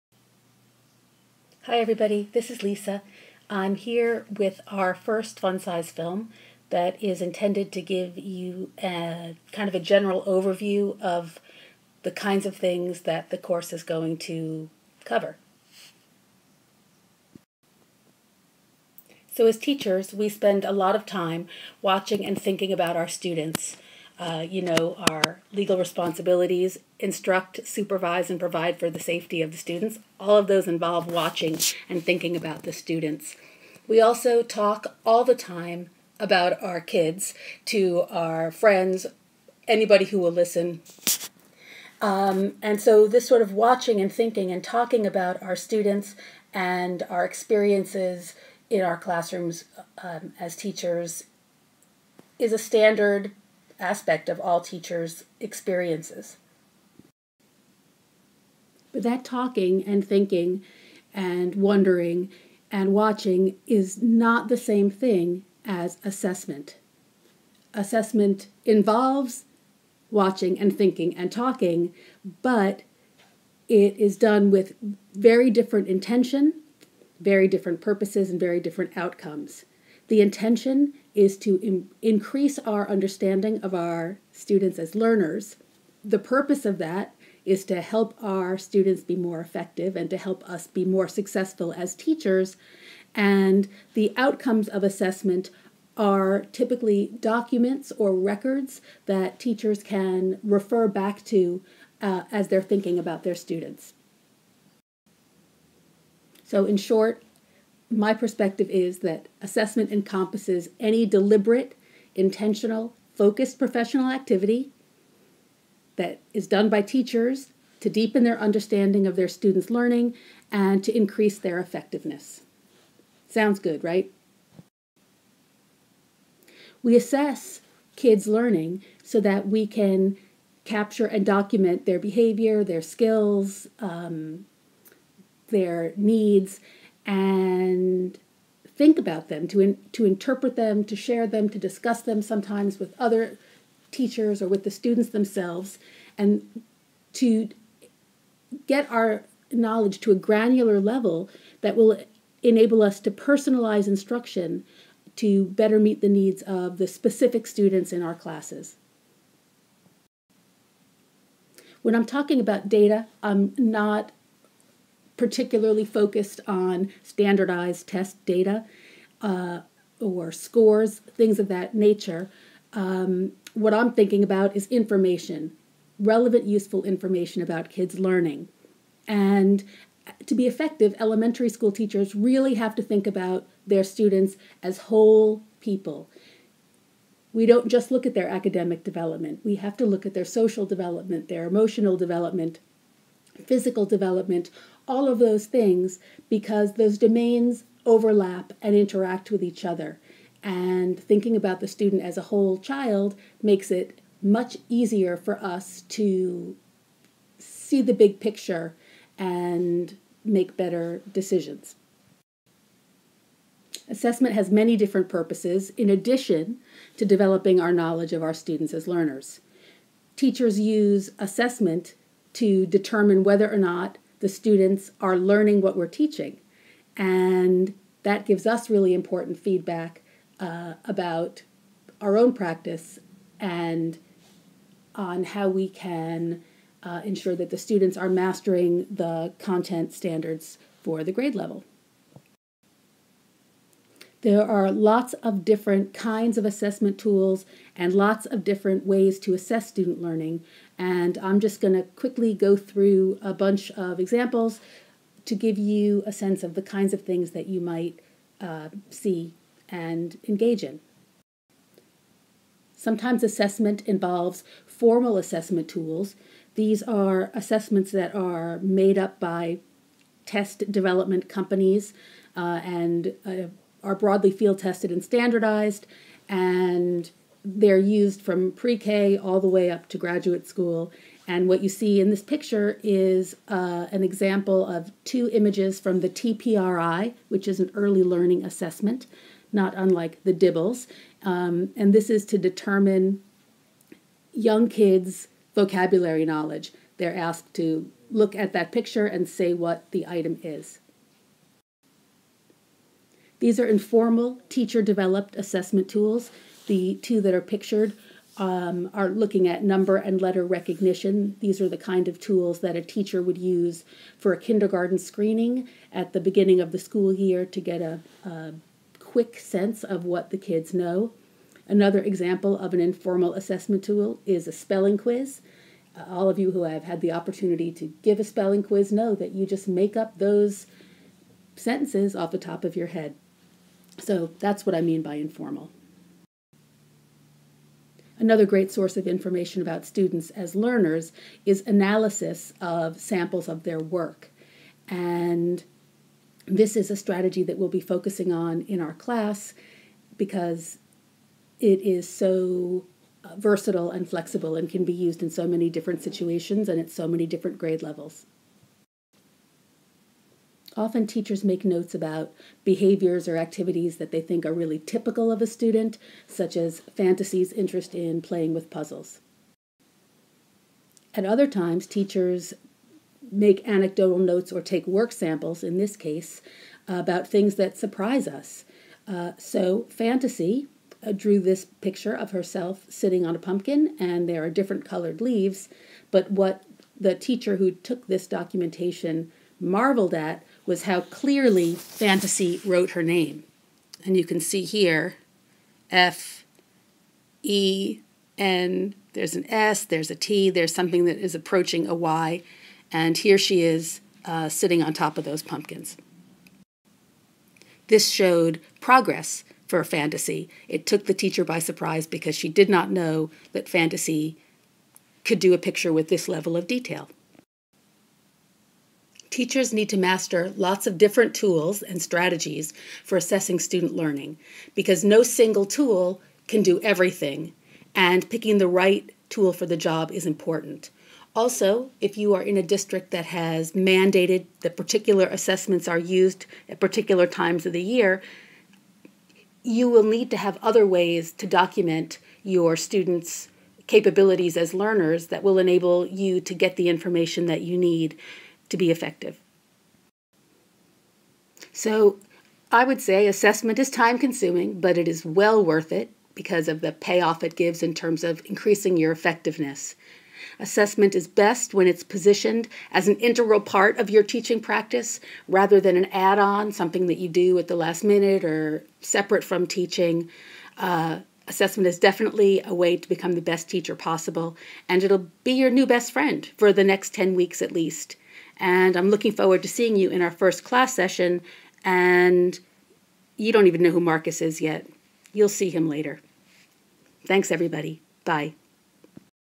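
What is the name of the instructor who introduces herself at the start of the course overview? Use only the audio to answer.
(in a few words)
Lisa.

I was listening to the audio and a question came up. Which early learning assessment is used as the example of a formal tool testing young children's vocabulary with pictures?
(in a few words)
TPRI.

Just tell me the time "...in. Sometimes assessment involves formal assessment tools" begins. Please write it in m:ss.
4:20.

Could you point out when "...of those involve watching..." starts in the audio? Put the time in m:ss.
0:30.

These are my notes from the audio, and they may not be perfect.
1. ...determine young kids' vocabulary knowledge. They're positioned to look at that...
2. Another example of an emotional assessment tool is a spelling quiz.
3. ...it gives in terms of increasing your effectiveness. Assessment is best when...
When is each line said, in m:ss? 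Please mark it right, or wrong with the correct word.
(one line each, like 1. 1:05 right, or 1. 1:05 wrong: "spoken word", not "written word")
1. 4:52 wrong: "asked", not "positioned"
2. 5:21 wrong: "informal", not "emotional"
3. 7:37 right.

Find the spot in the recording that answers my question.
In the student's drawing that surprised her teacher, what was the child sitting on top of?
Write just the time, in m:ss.
6:23.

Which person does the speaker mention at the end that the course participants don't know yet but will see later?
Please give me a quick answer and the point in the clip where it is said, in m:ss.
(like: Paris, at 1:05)
Marcus, at 8:03.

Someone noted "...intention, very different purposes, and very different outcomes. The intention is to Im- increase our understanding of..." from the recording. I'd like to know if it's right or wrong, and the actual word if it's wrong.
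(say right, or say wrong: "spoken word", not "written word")
right.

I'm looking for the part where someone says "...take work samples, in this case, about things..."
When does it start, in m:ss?
6:14.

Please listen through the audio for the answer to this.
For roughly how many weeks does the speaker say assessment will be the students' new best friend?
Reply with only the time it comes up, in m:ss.
7:57.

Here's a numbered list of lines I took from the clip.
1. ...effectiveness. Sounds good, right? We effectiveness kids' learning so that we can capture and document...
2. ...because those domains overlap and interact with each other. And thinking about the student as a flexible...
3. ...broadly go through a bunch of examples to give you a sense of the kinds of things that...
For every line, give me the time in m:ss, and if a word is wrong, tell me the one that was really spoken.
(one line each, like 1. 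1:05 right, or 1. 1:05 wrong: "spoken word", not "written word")
1. 2:01 wrong: "assess", not "effectiveness"
2. 3:16 wrong: "whole", not "flexible"
3. 4:11 wrong: "quickly", not "broadly".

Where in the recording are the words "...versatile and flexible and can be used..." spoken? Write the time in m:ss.
5:53.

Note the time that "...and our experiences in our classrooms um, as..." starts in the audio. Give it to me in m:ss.
0:46.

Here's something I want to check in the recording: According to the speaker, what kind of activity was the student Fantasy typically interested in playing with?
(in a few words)
puzzles.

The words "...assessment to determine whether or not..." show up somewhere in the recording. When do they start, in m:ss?
3:41.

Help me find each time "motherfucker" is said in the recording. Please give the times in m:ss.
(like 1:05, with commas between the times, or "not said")
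not said.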